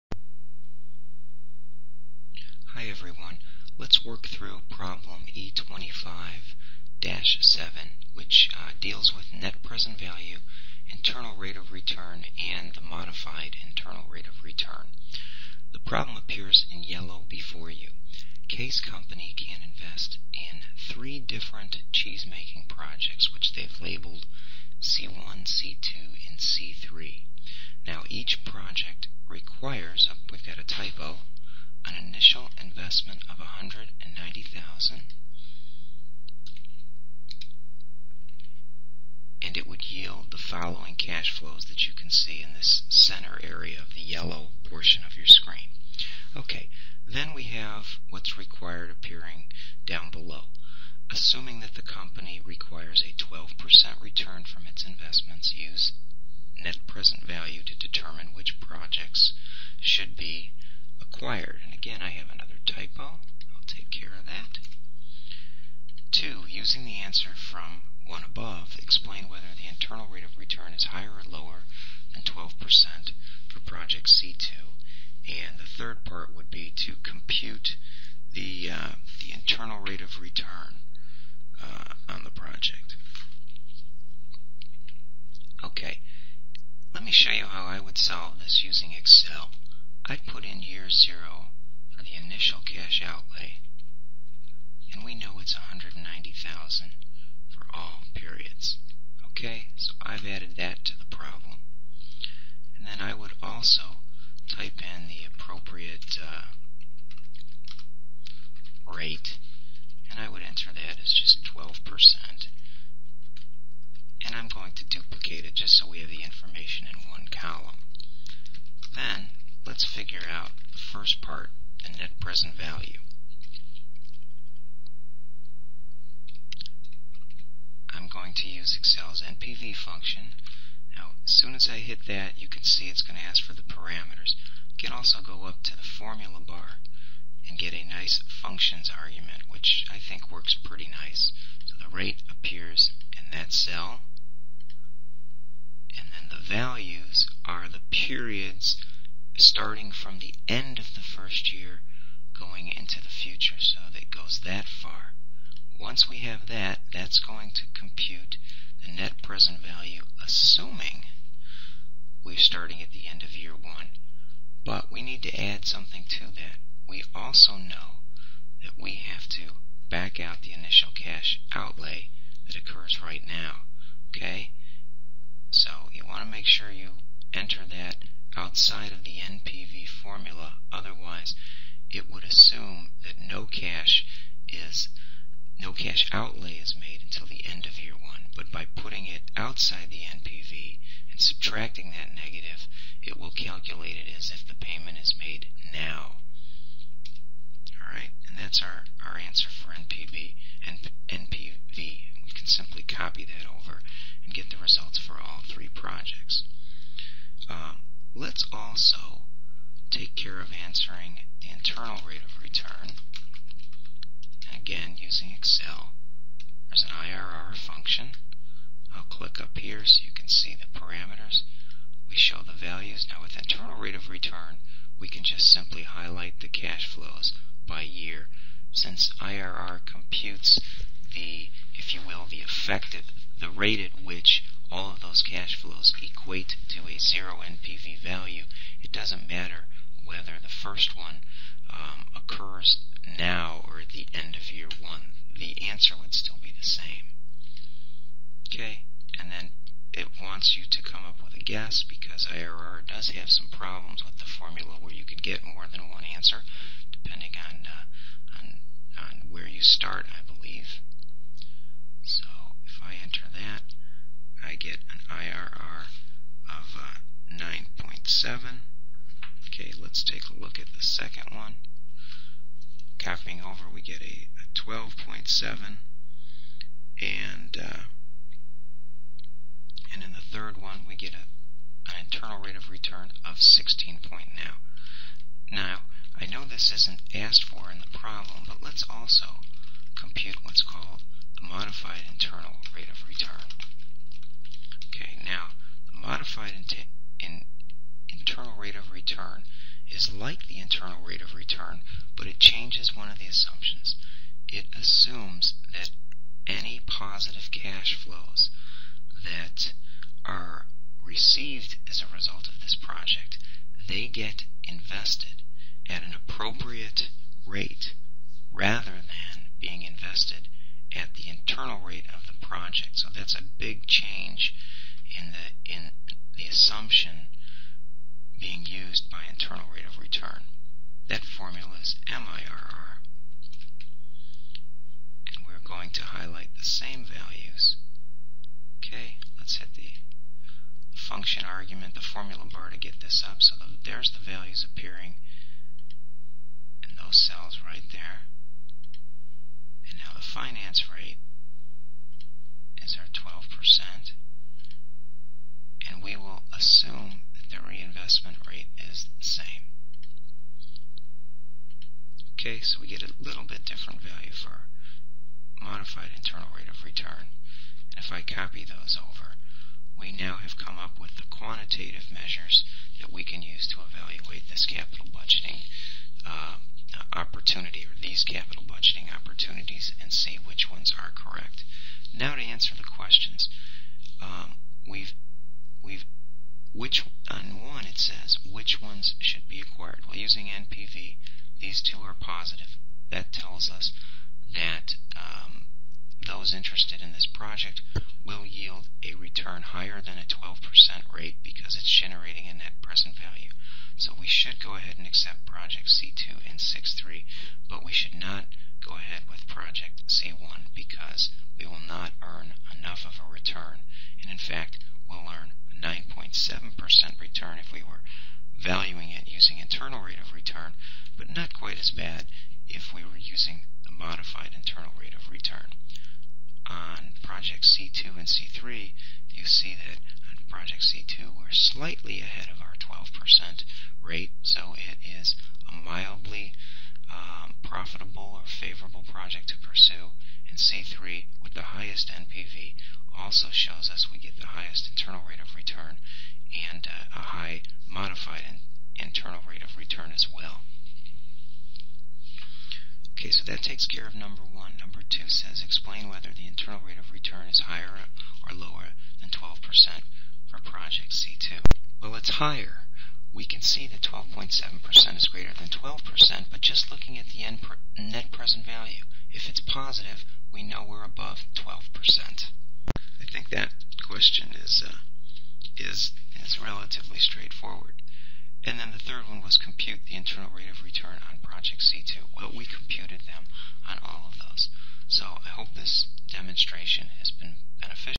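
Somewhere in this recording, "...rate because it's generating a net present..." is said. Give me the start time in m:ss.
6:41.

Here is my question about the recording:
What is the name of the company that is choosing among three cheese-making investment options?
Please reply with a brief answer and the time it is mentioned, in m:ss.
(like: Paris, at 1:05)
Case Company, at 0:18.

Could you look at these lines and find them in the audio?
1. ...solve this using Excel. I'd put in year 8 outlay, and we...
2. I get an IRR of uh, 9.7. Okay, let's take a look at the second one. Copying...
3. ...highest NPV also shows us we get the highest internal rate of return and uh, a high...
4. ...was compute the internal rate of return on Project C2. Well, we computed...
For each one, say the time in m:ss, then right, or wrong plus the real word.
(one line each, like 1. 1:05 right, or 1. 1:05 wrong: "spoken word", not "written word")
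1. 1:27 wrong: "0", not "8"
2. 4:24 right
3. 7:21 right
4. 7:59 right.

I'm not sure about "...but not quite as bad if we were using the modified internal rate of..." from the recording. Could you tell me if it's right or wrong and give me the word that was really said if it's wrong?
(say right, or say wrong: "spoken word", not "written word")
right.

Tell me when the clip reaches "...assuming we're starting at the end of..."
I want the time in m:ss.
2:40.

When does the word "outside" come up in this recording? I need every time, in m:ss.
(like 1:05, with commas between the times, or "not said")
2:58, 3:09.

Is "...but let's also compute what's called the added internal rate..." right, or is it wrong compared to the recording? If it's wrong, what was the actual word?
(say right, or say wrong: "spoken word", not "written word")
wrong: "modified", not "added".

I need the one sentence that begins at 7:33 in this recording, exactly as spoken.
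Okay, so that takes care of number one.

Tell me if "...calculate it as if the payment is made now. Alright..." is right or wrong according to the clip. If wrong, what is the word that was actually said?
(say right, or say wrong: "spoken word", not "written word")
right.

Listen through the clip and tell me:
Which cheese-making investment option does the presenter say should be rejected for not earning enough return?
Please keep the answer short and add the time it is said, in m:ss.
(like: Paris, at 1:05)
C1, at 6:49.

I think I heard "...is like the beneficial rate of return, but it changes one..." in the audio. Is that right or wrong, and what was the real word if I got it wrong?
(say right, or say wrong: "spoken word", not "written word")
wrong: "internal", not "beneficial".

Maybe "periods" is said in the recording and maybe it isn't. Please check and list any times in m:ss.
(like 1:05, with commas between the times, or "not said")
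1:38, 2:27.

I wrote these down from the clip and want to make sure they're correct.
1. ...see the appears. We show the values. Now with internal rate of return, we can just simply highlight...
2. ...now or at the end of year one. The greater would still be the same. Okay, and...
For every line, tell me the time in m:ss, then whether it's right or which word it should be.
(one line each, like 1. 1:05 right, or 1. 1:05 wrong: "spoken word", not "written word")
1. 3:40 wrong: "parameters", not "appears"
2. 4:03 wrong: "answer", not "greater".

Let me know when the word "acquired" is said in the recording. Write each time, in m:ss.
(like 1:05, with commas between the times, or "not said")
1:01, 6:29.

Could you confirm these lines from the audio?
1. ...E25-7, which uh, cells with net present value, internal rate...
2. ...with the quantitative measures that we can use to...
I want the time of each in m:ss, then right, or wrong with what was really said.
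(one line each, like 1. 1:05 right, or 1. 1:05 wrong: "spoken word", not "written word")
1. 0:05 wrong: "deals", not "cells"
2. 6:10 right.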